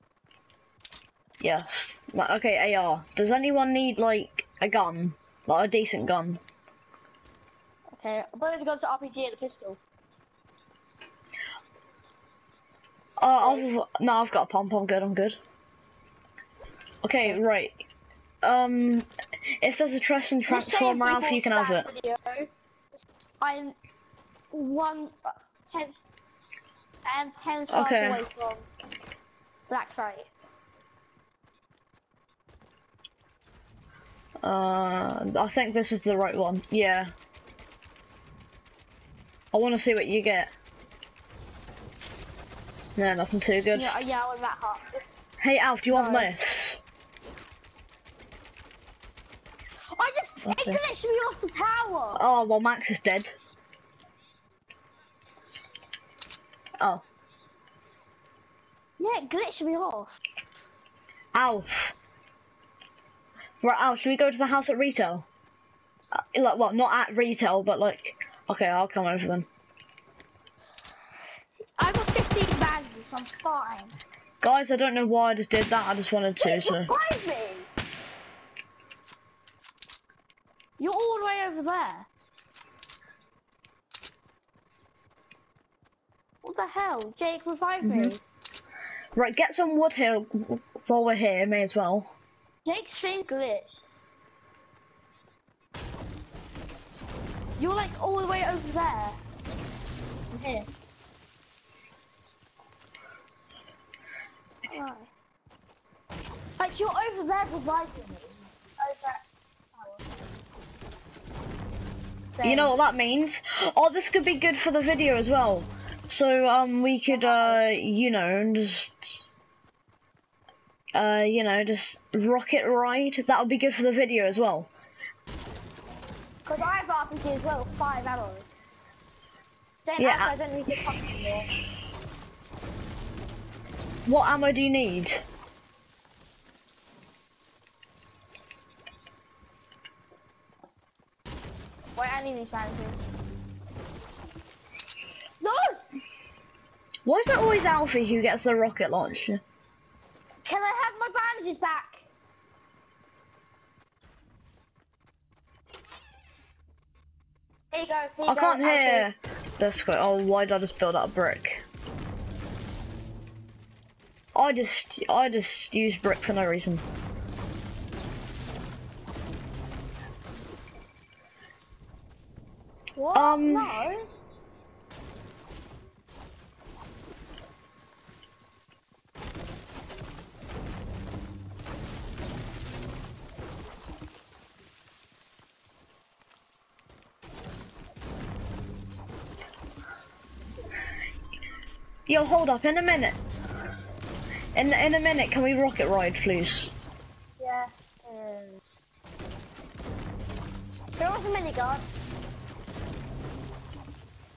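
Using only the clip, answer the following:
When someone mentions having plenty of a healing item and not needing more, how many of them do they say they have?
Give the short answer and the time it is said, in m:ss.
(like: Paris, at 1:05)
15, at 1:12.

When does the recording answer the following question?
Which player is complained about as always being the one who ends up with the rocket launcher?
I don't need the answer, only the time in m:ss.
2:27.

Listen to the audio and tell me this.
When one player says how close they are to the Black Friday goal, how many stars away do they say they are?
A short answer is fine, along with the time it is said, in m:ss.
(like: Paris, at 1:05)
10, at 0:27.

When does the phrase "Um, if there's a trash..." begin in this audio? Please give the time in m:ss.
0:18.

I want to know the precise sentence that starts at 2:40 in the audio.
Oh, why did I just build that brick?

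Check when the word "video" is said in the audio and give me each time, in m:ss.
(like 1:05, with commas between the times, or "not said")
0:21, 1:54, 2:03.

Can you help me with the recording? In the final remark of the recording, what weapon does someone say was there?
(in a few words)
A minigun.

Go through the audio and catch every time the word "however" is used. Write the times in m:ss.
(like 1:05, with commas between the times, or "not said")
not said.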